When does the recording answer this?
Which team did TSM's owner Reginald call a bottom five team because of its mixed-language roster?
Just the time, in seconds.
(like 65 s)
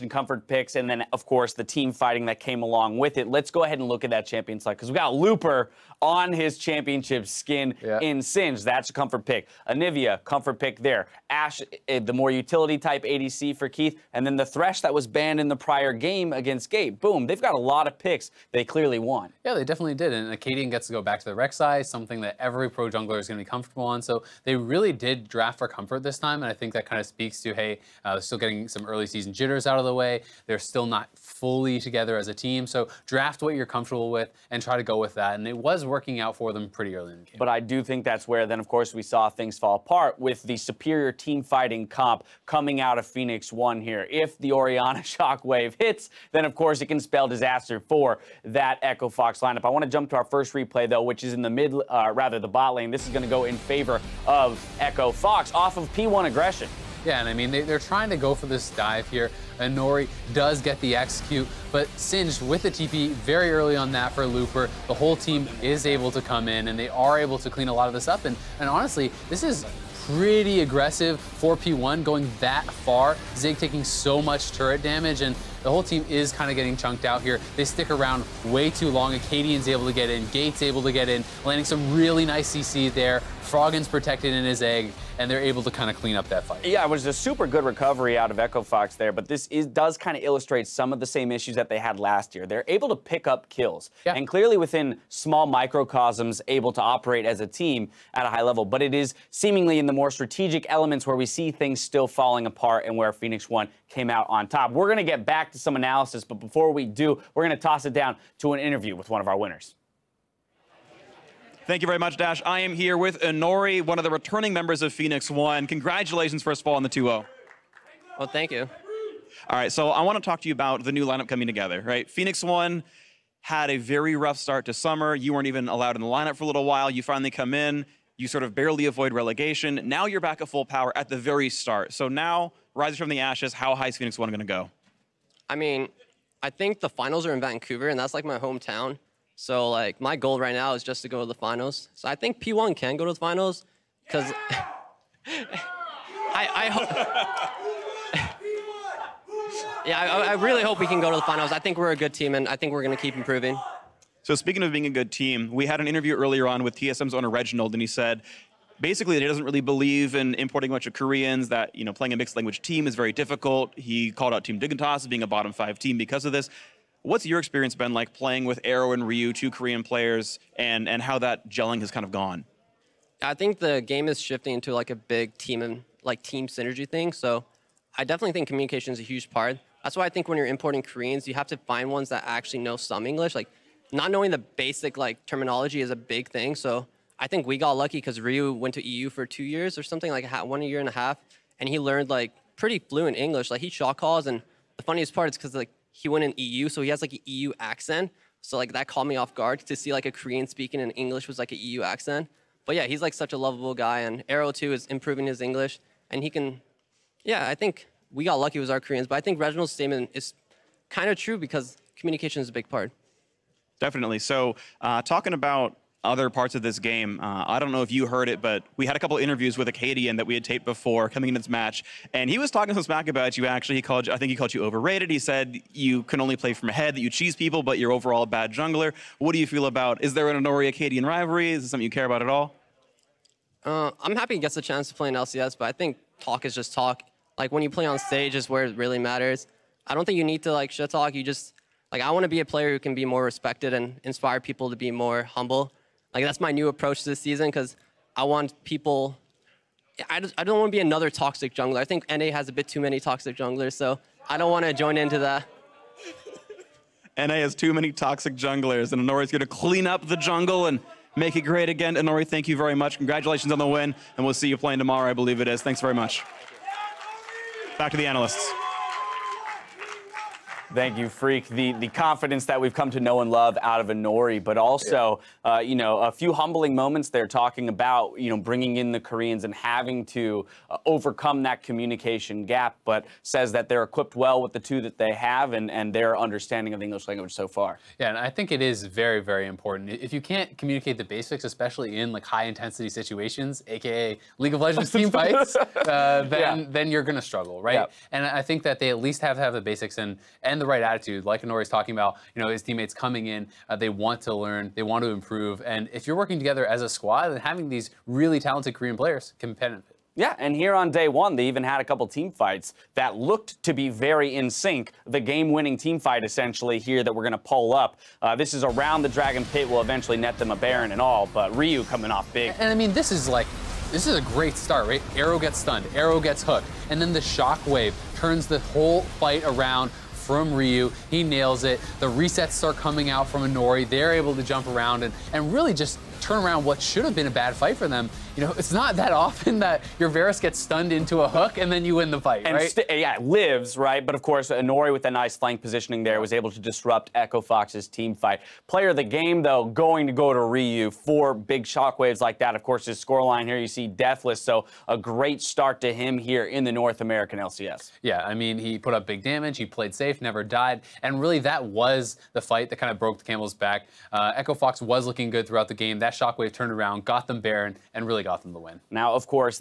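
164 s.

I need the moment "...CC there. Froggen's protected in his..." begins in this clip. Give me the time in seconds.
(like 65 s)
82 s.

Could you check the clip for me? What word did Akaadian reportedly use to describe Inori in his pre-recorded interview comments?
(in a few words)
overrated.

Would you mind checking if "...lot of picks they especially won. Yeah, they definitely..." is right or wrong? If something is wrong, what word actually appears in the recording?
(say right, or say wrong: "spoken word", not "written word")
wrong: "clearly", not "especially".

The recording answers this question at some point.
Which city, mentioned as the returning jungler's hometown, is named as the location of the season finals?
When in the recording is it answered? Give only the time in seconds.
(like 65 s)
137 s.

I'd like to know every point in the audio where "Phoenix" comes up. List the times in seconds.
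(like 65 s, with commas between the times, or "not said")
43 s, 103 s, 114 s, 122 s, 133 s.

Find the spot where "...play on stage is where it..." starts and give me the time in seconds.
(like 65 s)
237 s.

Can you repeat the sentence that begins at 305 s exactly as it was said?
And if you're working together as a squad, then having these really talented Korean players can benefit.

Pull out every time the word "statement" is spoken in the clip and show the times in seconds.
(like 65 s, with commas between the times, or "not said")
209 s.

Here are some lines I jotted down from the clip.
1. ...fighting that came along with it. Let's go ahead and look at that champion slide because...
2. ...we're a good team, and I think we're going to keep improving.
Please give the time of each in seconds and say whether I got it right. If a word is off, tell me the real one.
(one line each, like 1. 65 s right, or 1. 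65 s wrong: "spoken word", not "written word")
1. 1 s right
2. 151 s right.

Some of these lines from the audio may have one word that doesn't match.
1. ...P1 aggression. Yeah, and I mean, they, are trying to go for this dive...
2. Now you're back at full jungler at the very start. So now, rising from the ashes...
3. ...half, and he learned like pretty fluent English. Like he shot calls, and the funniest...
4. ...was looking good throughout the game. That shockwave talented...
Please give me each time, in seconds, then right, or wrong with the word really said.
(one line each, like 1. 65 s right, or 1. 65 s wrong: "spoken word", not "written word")
1. 55 s right
2. 129 s wrong: "power", not "jungler"
3. 190 s right
4. 364 s wrong: "turned", not "talented".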